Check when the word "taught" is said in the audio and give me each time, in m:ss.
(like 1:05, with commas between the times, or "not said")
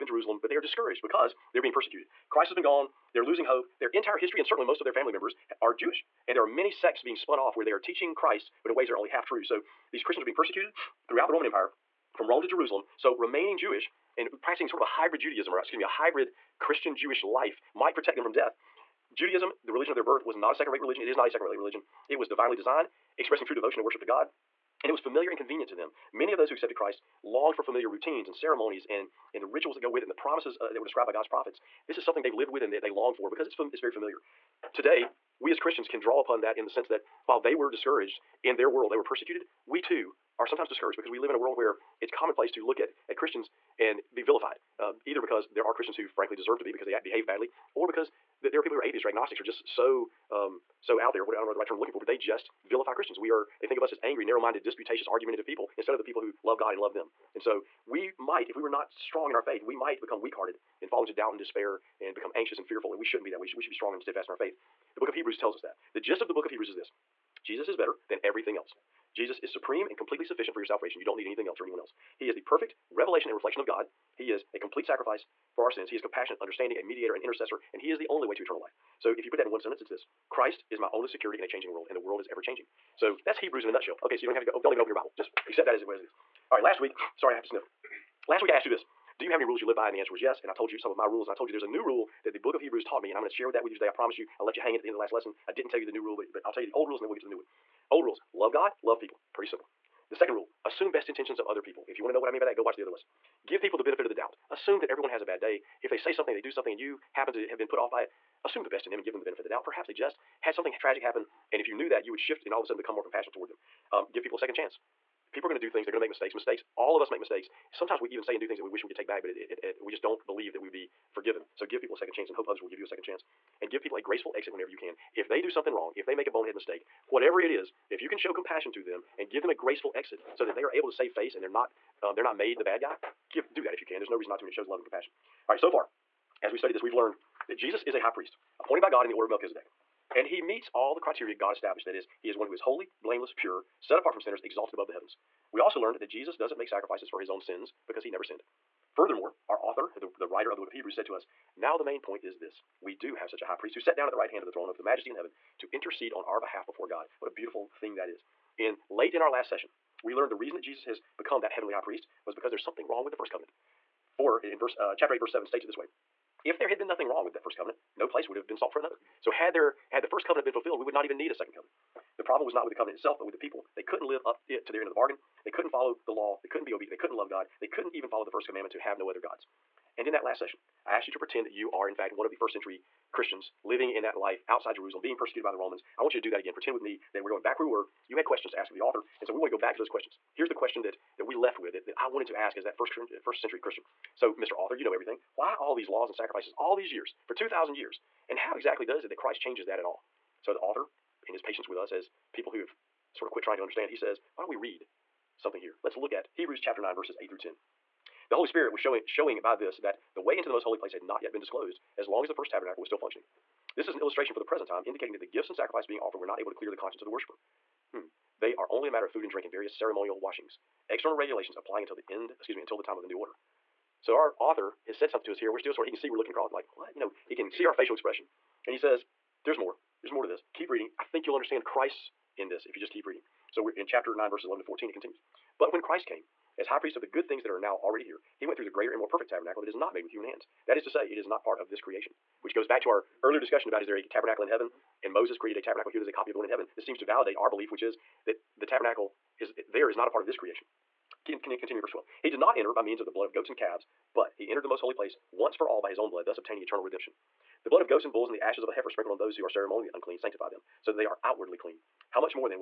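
1:32.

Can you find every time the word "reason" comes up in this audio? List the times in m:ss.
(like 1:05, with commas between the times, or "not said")
2:14, 2:40.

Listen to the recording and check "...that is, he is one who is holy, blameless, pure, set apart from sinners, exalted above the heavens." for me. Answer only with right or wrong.
right.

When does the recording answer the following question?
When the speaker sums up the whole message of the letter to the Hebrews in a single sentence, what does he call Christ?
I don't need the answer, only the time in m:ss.
1:20.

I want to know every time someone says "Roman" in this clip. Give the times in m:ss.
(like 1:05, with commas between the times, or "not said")
0:11, 3:05.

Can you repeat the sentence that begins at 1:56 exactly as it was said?
Mistakes, all of us make mistakes.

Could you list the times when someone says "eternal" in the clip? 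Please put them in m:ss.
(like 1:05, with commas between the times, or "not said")
1:18, 4:16.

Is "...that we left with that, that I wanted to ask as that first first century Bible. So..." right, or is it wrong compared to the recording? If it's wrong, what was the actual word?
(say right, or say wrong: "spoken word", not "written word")
wrong: "Christian", not "Bible".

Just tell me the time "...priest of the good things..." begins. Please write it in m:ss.
3:56.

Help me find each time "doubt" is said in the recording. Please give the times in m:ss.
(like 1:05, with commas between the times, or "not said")
1:01, 1:44, 1:49.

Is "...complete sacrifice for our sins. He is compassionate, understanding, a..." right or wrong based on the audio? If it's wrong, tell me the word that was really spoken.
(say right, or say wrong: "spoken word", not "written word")
right.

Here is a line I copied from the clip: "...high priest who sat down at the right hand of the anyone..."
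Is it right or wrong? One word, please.
wrong.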